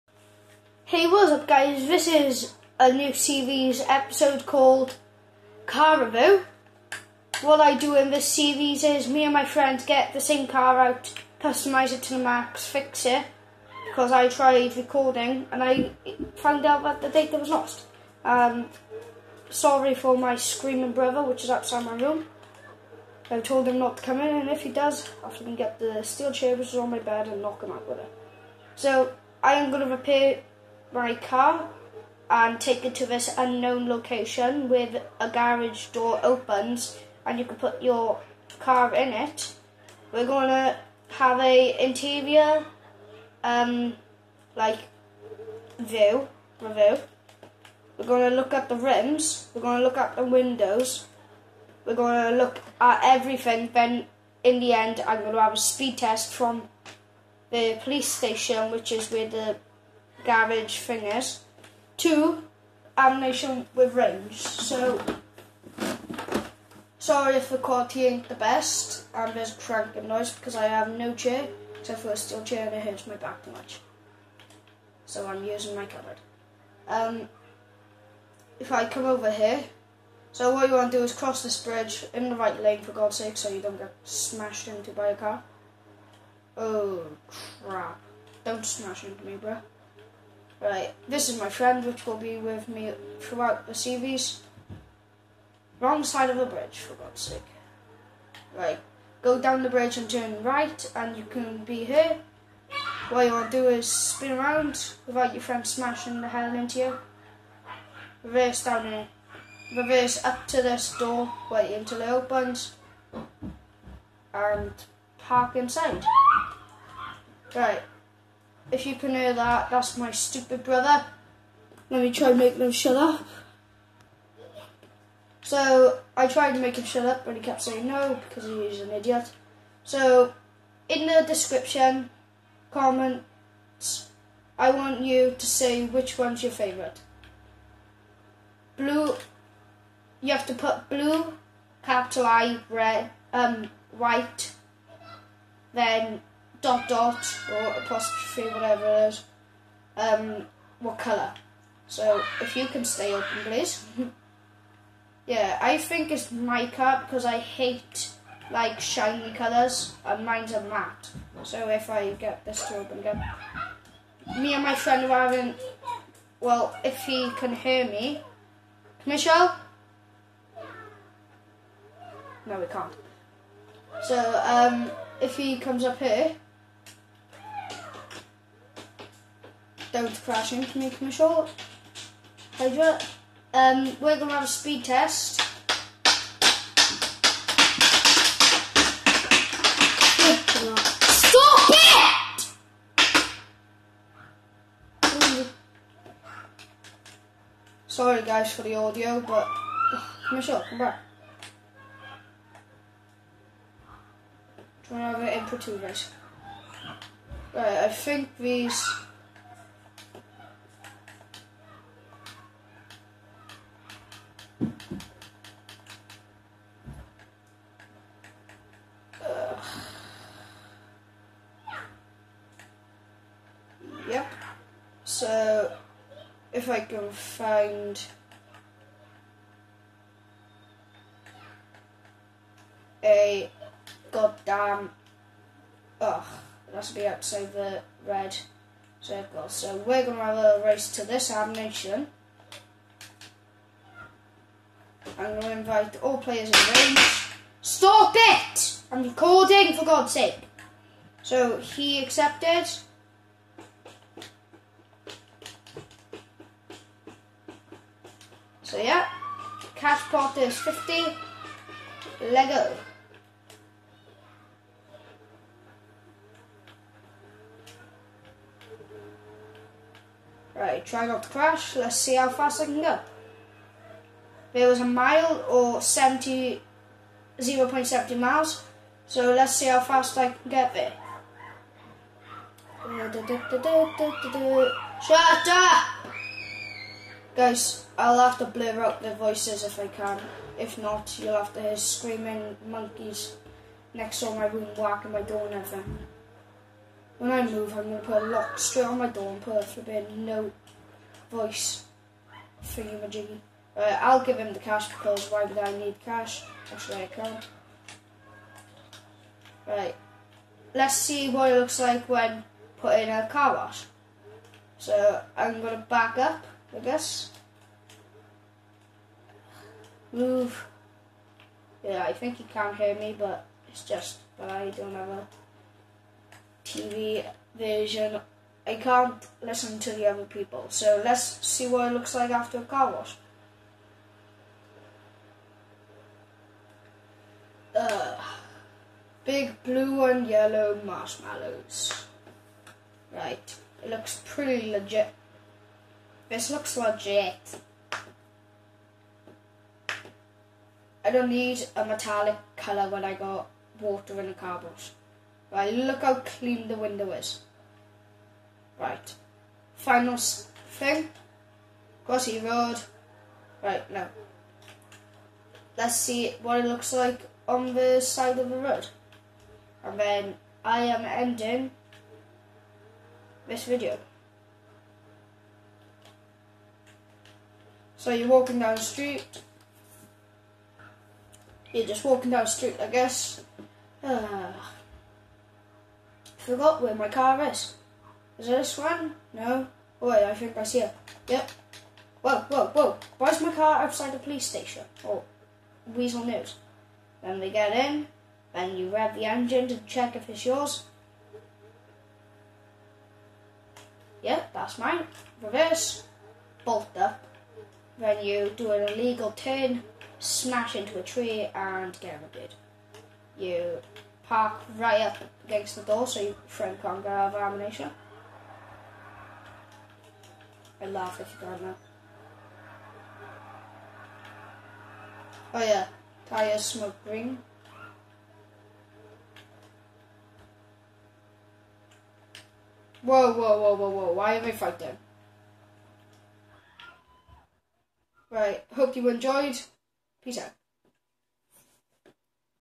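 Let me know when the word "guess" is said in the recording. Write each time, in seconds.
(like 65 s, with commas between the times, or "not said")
316 s, 382 s.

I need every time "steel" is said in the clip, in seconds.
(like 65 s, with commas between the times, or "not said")
26 s, 72 s.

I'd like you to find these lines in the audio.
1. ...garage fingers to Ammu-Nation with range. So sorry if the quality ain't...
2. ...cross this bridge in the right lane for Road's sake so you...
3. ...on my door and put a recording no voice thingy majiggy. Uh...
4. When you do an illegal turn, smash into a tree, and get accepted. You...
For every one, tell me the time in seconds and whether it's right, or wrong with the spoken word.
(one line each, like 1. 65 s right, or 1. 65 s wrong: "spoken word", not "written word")
1. 60 s right
2. 81 s wrong: "God", not "Road"
3. 298 s wrong: "flipping", not "recording"
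4. 408 s wrong: "rounded", not "accepted".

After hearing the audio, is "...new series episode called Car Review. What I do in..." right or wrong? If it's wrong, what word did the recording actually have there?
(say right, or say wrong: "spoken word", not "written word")
right.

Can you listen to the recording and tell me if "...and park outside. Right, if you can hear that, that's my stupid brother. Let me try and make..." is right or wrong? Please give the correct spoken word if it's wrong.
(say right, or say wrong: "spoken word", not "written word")
wrong: "inside", not "outside".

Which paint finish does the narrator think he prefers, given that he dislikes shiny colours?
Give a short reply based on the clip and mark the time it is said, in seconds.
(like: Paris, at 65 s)
mica, at 156 s.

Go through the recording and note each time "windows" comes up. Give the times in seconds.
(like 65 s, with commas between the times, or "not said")
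50 s, 356 s.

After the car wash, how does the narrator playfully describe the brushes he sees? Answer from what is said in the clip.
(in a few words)
big blue and yellow marshmallows.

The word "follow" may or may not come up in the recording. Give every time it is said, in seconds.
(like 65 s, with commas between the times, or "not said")
not said.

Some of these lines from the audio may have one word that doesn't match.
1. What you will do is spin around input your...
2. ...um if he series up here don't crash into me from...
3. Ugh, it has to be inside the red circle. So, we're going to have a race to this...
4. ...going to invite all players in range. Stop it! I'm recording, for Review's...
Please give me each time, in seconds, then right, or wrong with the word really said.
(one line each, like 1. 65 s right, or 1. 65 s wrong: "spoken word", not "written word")
1. 103 s wrong: "without", not "input"
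2. 174 s wrong: "comes", not "series"
3. 236 s wrong: "outside", not "inside"
4. 245 s wrong: "God", not "Review".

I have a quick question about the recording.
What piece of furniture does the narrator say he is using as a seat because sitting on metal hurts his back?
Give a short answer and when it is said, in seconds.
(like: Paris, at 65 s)
cupboard, at 75 s.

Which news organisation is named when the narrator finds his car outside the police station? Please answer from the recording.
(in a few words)
Weazel News.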